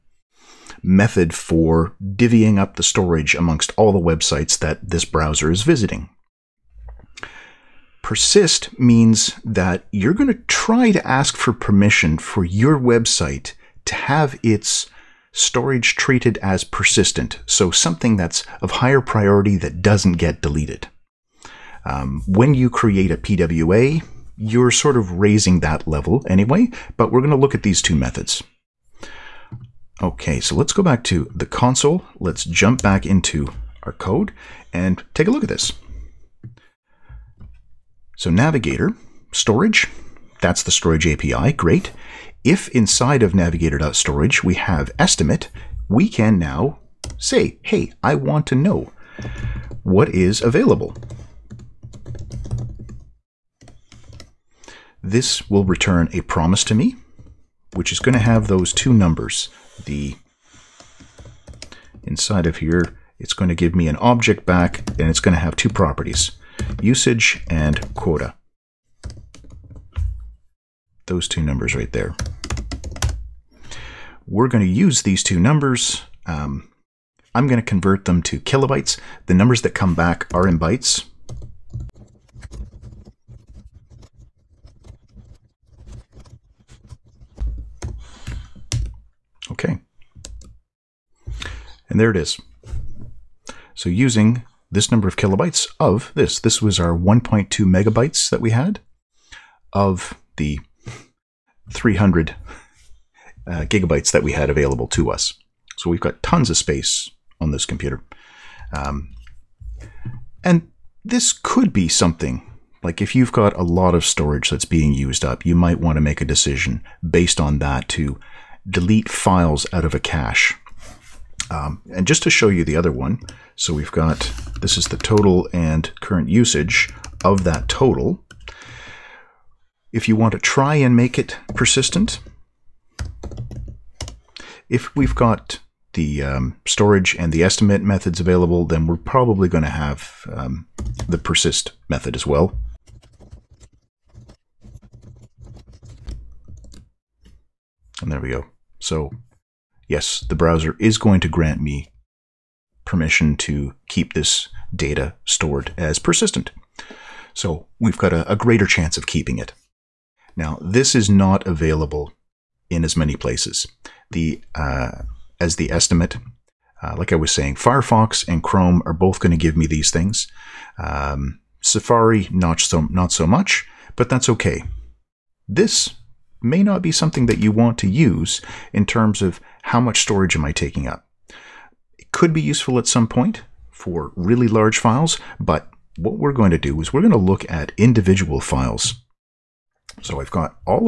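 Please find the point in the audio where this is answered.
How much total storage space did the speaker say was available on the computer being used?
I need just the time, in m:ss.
1:41.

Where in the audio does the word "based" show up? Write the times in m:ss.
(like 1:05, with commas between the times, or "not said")
1:57.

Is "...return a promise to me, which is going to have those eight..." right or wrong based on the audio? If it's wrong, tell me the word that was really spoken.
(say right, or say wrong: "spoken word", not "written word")
wrong: "two", not "eight".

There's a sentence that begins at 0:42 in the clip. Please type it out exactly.
If inside of navigator.storage we have estimate, we can now say, hey, I want to know what is available.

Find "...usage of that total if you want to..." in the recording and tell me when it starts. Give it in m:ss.
2:06.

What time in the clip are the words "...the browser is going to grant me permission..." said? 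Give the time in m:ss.
2:30.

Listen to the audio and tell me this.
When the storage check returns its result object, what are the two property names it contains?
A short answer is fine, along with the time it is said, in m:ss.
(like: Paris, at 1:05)
usage and quota, at 1:06.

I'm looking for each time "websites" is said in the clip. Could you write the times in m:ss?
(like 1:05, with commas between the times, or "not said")
0:03, 0:12.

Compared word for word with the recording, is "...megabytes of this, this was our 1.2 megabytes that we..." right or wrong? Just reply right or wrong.
wrong.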